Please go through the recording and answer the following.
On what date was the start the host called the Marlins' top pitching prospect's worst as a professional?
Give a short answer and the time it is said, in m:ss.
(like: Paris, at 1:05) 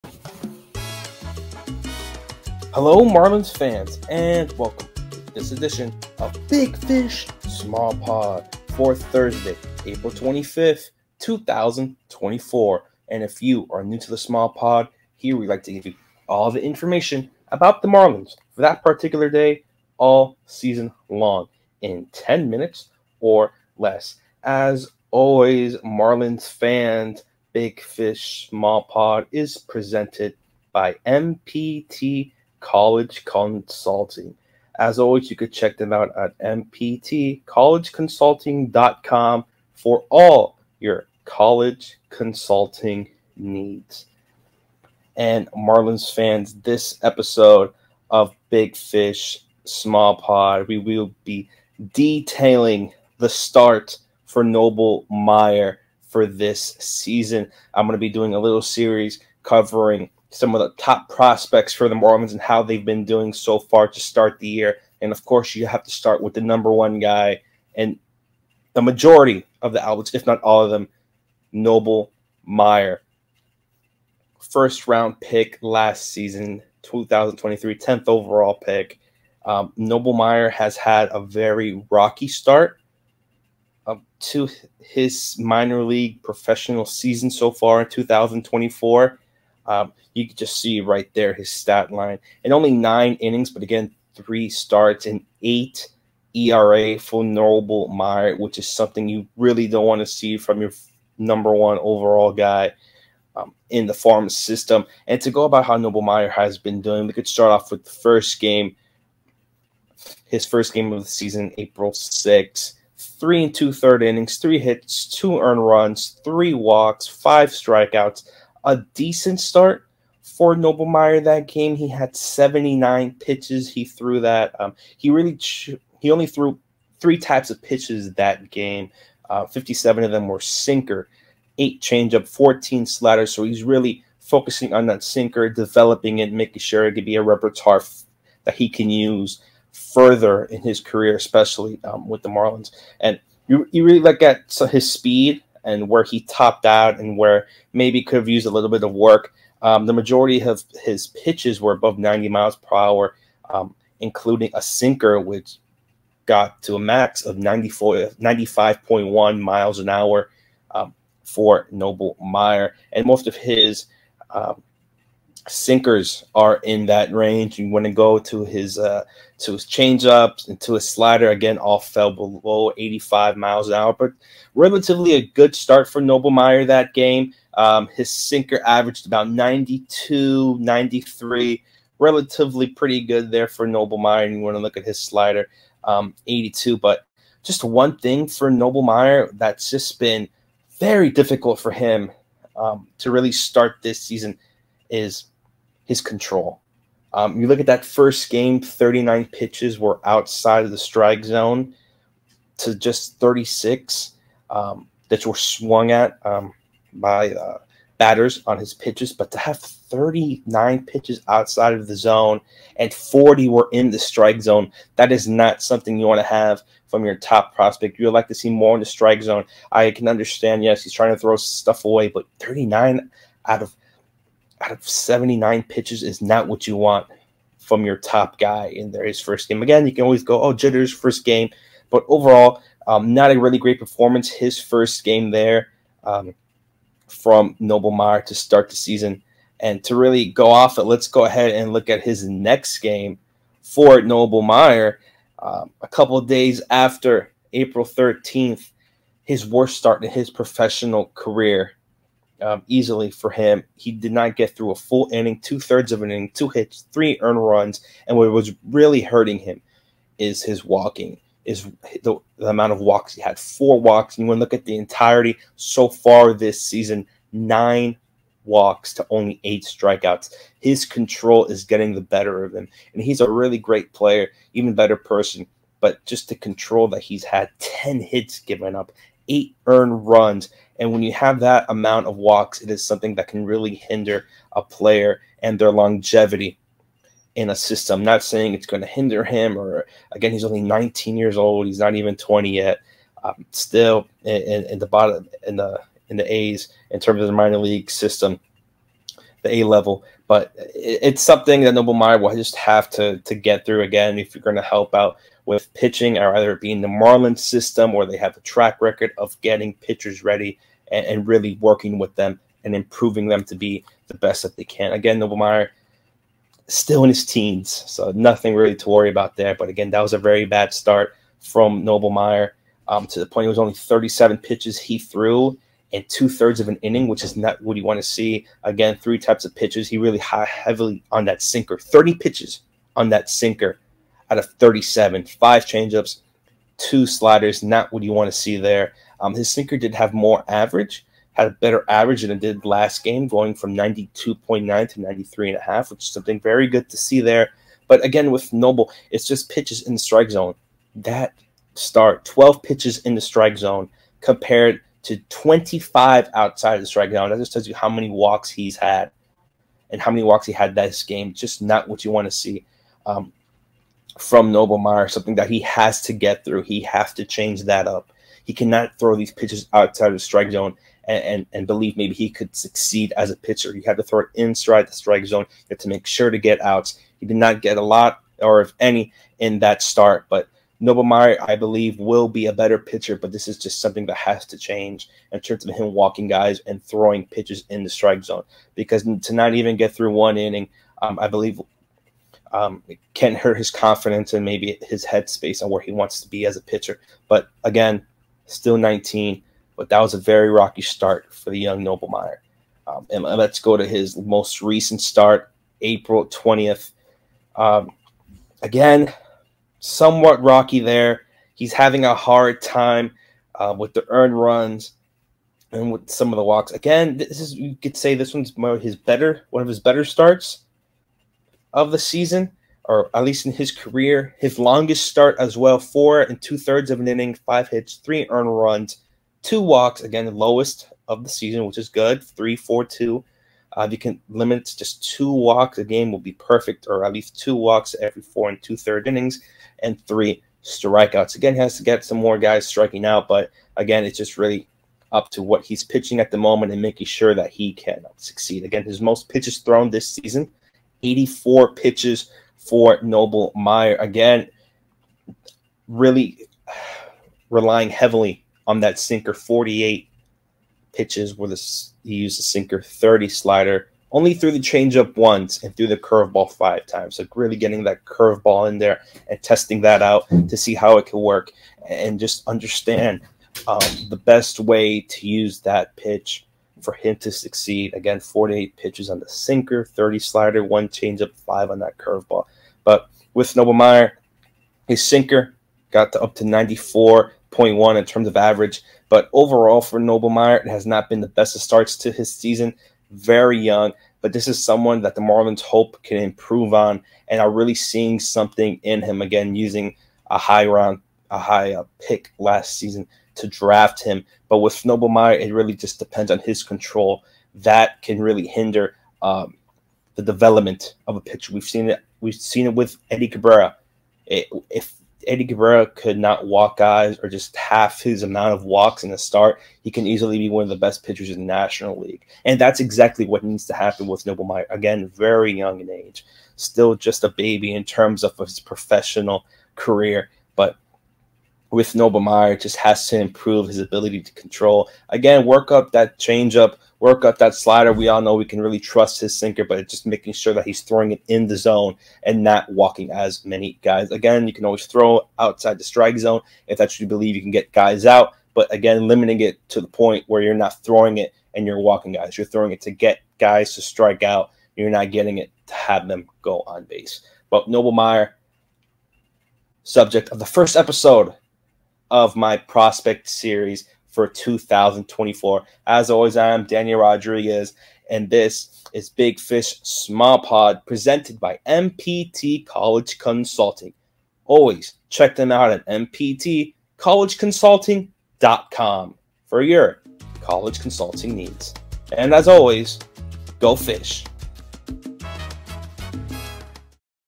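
April 13th, at 4:07.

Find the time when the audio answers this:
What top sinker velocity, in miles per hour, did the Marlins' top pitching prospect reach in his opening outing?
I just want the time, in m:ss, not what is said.
2:38.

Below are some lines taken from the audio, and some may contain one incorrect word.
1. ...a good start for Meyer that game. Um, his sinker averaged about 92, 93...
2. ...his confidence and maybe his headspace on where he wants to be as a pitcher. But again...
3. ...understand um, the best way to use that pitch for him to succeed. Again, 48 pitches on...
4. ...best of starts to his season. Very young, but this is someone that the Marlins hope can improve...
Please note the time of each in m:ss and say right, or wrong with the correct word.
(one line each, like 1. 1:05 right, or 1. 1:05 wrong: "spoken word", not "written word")
1. 2:55 right
2. 6:33 right
3. 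7:52 right
4. 8:11 right.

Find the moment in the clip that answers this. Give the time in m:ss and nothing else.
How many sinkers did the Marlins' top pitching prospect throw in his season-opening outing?
2:09.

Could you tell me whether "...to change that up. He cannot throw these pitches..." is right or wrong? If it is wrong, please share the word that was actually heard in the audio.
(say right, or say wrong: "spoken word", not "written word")
right.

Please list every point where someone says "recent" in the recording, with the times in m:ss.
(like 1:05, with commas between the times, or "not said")
6:44.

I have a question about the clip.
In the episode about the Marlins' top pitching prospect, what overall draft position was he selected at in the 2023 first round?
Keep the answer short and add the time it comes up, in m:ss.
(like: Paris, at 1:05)
10th overall, at 1:17.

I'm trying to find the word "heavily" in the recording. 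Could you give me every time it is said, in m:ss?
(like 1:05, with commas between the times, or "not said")
5:30, 7:37.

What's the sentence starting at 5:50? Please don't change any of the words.
That start, 12 pitches in the strike zone compared to 25 outside of the strike zone.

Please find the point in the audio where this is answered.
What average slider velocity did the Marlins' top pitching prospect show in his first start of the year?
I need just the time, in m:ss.
3:06.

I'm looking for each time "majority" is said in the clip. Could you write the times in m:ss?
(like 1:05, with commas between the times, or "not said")
1:08, 2:29.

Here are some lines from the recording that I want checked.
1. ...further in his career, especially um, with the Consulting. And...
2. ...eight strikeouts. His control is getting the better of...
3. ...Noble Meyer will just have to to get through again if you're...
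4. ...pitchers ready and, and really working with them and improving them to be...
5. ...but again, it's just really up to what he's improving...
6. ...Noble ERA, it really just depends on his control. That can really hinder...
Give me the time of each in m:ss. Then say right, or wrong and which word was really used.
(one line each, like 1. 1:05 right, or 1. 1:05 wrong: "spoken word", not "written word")
1. 2:19 wrong: "Marlins", not "Consulting"
2. 4:29 right
3. 5:01 right
4. 5:09 right
5. 7:23 wrong: "pitching", not "improving"
6. 8:24 wrong: "Meyer", not "ERA".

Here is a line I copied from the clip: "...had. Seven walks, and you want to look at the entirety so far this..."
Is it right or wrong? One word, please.
wrong.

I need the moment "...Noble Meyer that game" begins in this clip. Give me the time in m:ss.
2:00.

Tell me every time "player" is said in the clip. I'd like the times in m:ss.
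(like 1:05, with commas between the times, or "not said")
4:33, 4:44.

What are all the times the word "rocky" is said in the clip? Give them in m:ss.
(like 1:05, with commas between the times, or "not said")
1:21, 6:40, 6:50.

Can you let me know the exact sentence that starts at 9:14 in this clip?
You're not getting it to have them go on base.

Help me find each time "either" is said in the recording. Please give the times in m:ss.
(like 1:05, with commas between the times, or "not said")
5:06.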